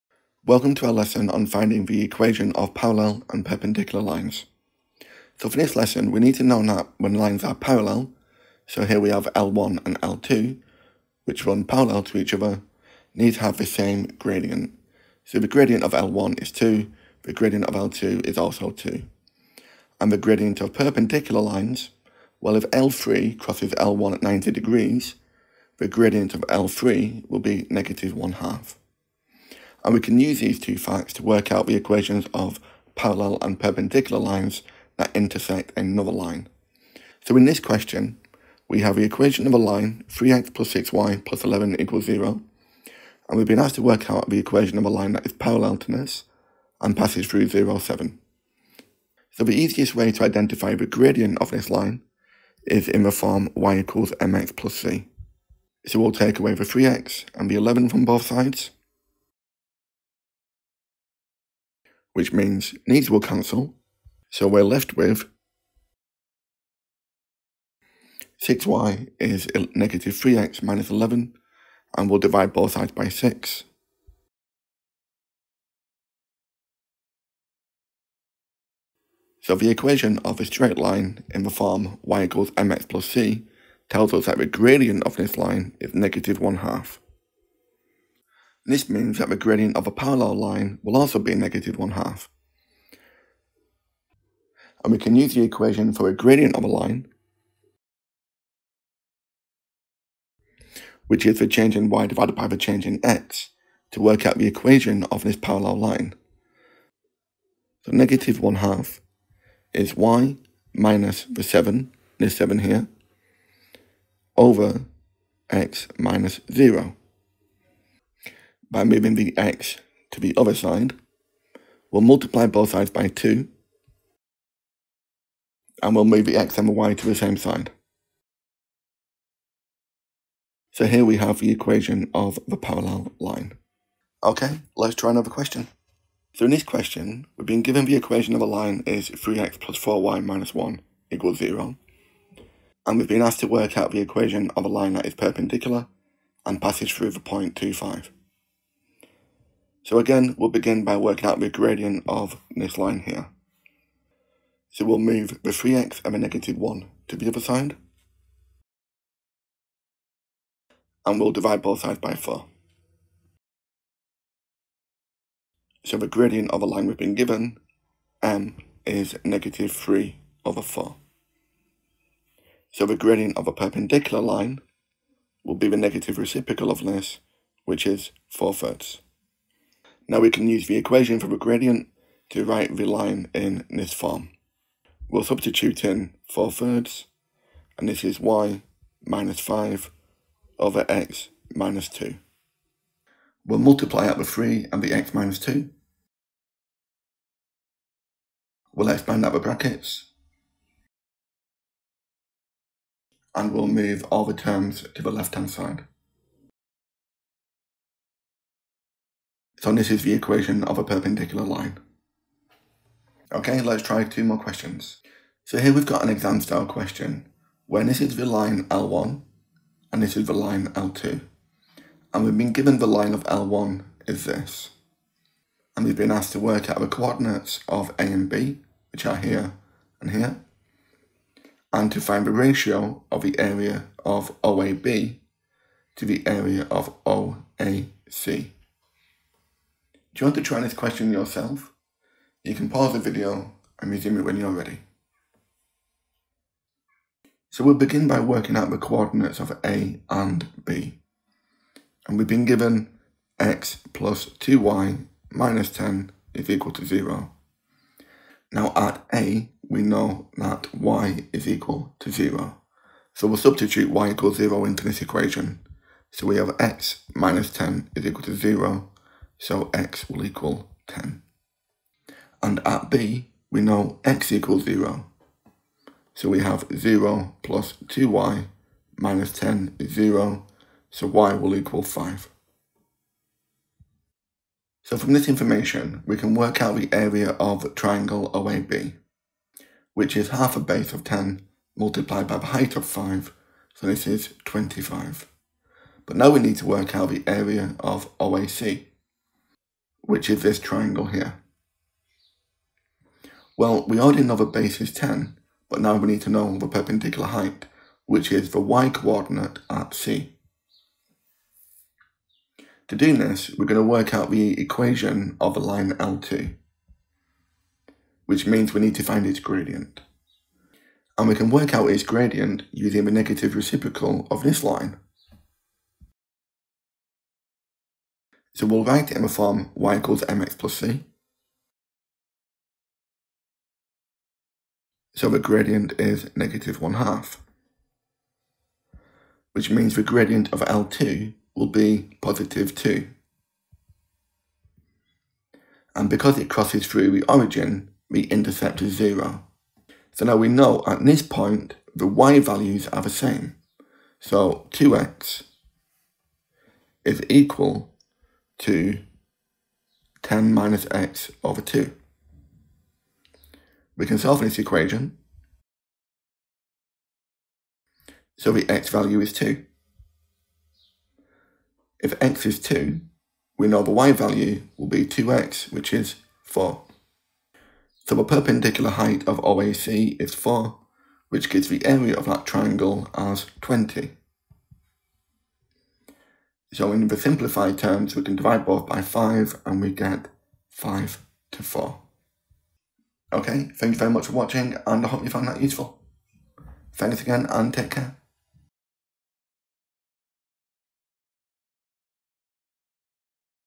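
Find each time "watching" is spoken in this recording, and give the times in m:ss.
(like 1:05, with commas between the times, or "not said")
6:34.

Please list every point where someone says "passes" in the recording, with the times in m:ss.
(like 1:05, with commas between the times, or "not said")
0:46, 2:26.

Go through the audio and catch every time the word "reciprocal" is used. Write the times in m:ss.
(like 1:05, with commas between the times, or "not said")
2:56, 5:23.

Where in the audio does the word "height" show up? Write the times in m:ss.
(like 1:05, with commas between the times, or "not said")
4:52, 5:07, 6:18.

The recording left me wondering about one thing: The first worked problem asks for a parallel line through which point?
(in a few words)
(0, 7).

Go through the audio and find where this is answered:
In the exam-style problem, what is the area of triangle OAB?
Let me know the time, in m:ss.
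4:54.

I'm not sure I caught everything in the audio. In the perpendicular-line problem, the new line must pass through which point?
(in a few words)
(2, 5).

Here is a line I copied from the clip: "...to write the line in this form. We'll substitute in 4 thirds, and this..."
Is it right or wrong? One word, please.
right.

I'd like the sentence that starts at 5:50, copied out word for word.
So now we know at this point the y values are the same.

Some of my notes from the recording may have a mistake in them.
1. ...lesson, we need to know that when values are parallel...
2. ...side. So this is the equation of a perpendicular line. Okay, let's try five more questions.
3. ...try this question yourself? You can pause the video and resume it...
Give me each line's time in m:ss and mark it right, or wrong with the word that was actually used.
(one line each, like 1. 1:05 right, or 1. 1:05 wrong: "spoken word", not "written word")
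1. 0:05 wrong: "lines", not "values"
2. 3:25 wrong: "two", not "five"
3. 4:00 right.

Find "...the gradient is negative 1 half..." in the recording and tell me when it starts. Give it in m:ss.
5:35.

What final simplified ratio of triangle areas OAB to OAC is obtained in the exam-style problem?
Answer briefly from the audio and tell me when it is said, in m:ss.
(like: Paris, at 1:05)
5 to 4, at 6:30.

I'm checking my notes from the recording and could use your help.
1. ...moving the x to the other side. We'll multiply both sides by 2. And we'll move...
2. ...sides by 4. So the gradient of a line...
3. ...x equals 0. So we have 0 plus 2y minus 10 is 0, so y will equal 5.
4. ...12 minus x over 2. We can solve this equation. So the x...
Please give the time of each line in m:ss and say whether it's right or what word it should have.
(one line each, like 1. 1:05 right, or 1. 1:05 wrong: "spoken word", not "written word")
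1. 1:58 right
2. 2:41 right
3. 4:34 right
4. 6:00 wrong: "10", not "12".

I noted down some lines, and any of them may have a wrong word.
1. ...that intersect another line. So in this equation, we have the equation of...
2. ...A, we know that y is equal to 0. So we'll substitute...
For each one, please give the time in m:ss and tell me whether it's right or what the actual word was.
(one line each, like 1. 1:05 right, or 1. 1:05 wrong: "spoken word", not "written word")
1. 0:34 wrong: "question", not "equation"
2. 4:19 right.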